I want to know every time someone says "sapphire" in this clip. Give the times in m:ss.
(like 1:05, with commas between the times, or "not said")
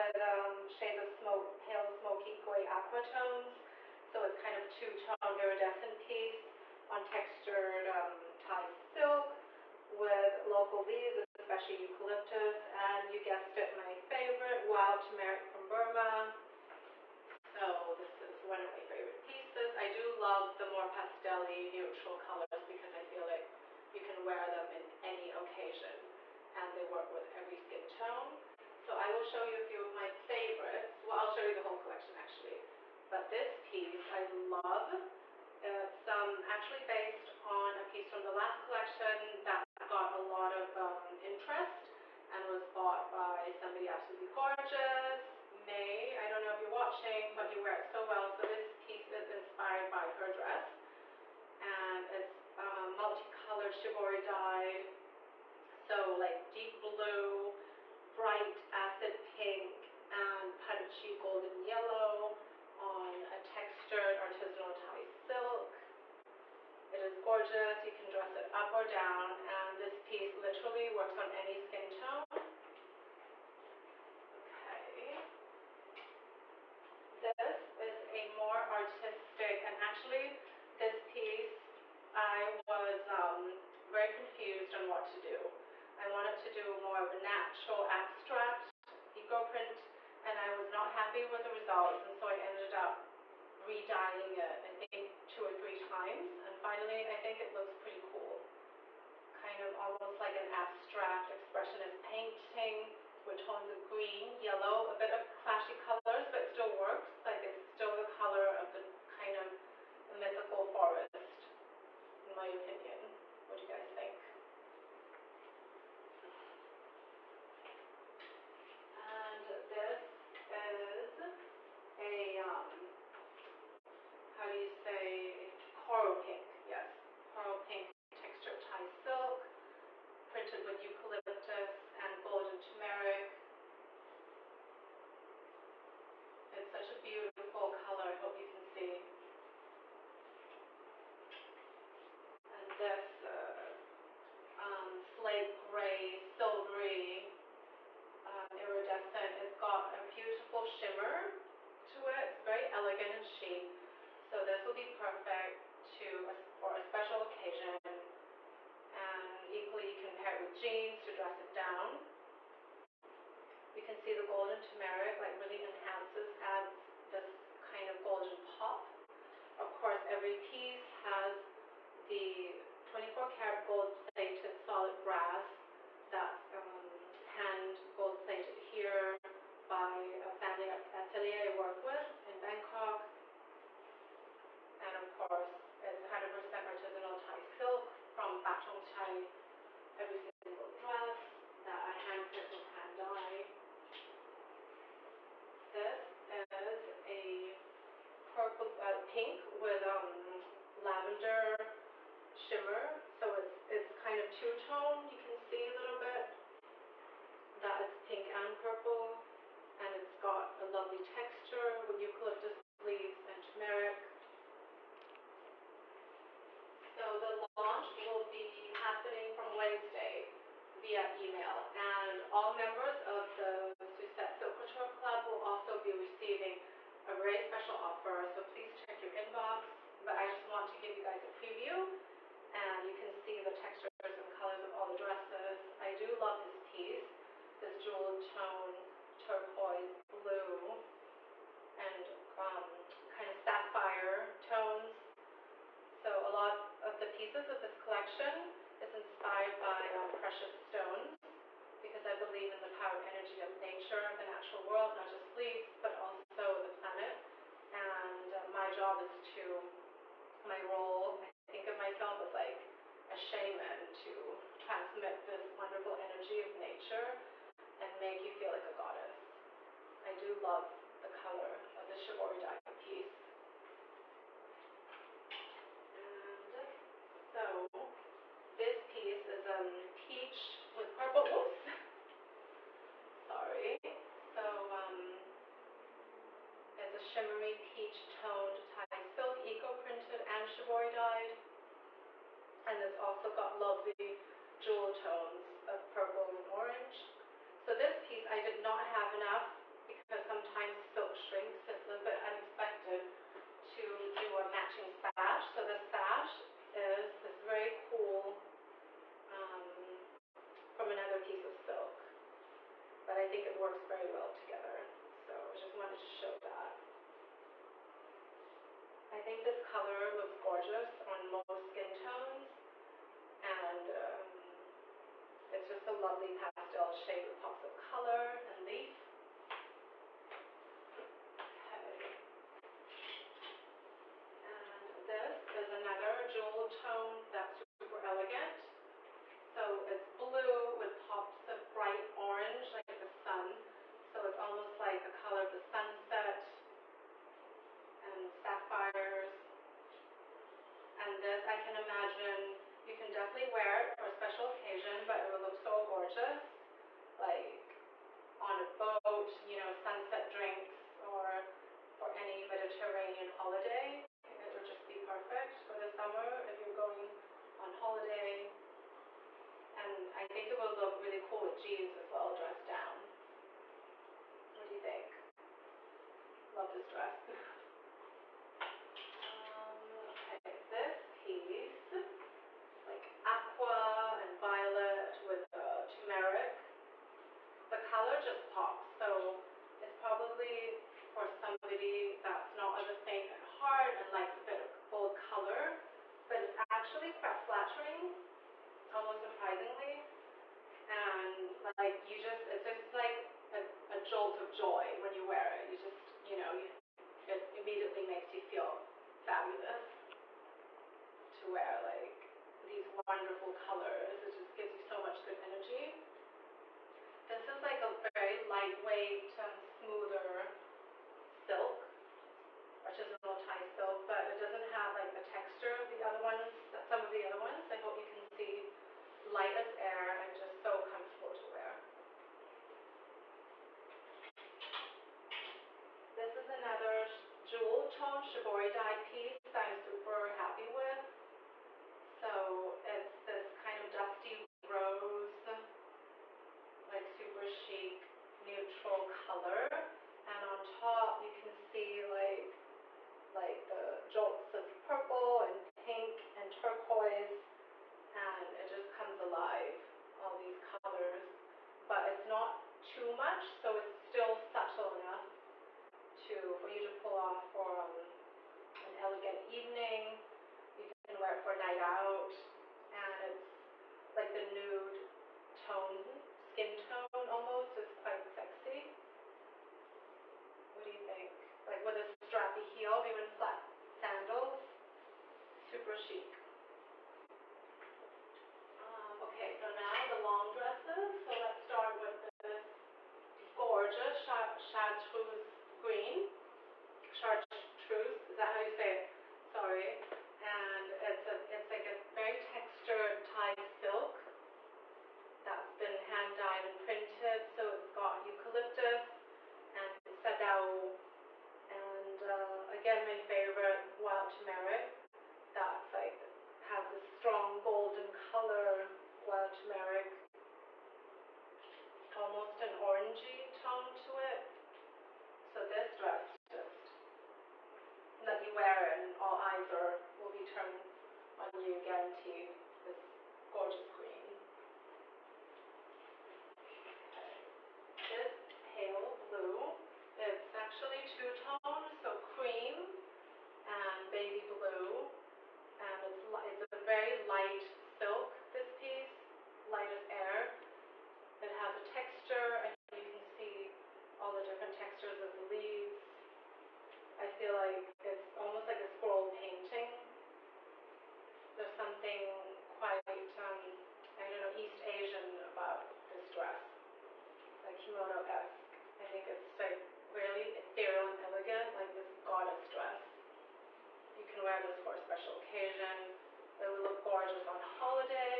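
4:03, 5:48.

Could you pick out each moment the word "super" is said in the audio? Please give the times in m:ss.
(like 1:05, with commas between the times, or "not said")
5:37, 7:19, 7:27, 8:05.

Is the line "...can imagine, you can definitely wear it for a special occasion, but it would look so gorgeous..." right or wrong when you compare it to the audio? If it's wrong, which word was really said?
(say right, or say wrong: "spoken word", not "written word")
right.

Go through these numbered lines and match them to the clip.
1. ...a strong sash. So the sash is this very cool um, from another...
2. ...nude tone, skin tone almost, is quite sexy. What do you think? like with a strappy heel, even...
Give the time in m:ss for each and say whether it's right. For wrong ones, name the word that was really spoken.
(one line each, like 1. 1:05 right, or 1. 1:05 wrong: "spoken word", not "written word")
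1. 5:04 wrong: "matching", not "strong"
2. 7:54 right.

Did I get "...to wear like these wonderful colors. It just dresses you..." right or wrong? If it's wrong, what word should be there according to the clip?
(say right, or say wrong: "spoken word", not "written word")
wrong: "gives", not "dresses".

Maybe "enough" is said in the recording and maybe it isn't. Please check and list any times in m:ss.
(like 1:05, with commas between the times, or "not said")
4:59, 7:45.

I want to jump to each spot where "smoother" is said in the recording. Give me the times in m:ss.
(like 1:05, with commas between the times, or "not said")
6:59.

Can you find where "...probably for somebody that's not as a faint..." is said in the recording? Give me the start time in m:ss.
6:29.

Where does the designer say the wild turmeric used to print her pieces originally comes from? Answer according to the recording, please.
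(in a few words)
Burma.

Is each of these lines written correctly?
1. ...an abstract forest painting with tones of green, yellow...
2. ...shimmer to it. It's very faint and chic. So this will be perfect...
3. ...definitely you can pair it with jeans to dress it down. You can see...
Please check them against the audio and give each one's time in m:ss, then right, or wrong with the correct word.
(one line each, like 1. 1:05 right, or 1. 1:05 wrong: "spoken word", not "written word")
1. 1:40 wrong: "expressionist", not "forest"
2. 2:30 wrong: "elegant", not "faint"
3. 2:39 wrong: "equally", not "definitely".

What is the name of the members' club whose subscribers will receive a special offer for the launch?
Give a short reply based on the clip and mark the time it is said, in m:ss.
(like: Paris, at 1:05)
Sucette Silkworm Club, at 3:43.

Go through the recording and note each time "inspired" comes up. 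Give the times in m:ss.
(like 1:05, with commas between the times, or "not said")
0:49, 4:08.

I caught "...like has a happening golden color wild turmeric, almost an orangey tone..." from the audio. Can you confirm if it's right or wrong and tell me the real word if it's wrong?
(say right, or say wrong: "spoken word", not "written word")
wrong: "strong", not "happening".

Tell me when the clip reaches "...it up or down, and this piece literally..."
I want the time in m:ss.
1:08.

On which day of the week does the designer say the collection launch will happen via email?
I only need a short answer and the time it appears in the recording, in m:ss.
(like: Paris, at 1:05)
Wednesday, at 3:39.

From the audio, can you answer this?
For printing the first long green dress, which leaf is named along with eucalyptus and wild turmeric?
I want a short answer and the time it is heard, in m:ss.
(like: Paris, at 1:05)
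sadao, at 8:30.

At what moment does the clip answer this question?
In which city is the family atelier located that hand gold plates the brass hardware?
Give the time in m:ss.
3:02.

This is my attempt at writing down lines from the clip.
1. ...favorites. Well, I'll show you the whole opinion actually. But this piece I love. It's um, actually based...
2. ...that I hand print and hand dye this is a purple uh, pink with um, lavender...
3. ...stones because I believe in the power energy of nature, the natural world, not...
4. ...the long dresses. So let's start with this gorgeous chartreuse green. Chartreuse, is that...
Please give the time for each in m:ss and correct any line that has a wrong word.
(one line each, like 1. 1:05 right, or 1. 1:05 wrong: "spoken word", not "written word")
1. 0:30 wrong: "collection", not "opinion"
2. 3:11 right
3. 4:10 right
4. 8:10 right.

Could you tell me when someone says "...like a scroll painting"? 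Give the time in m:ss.
9:18.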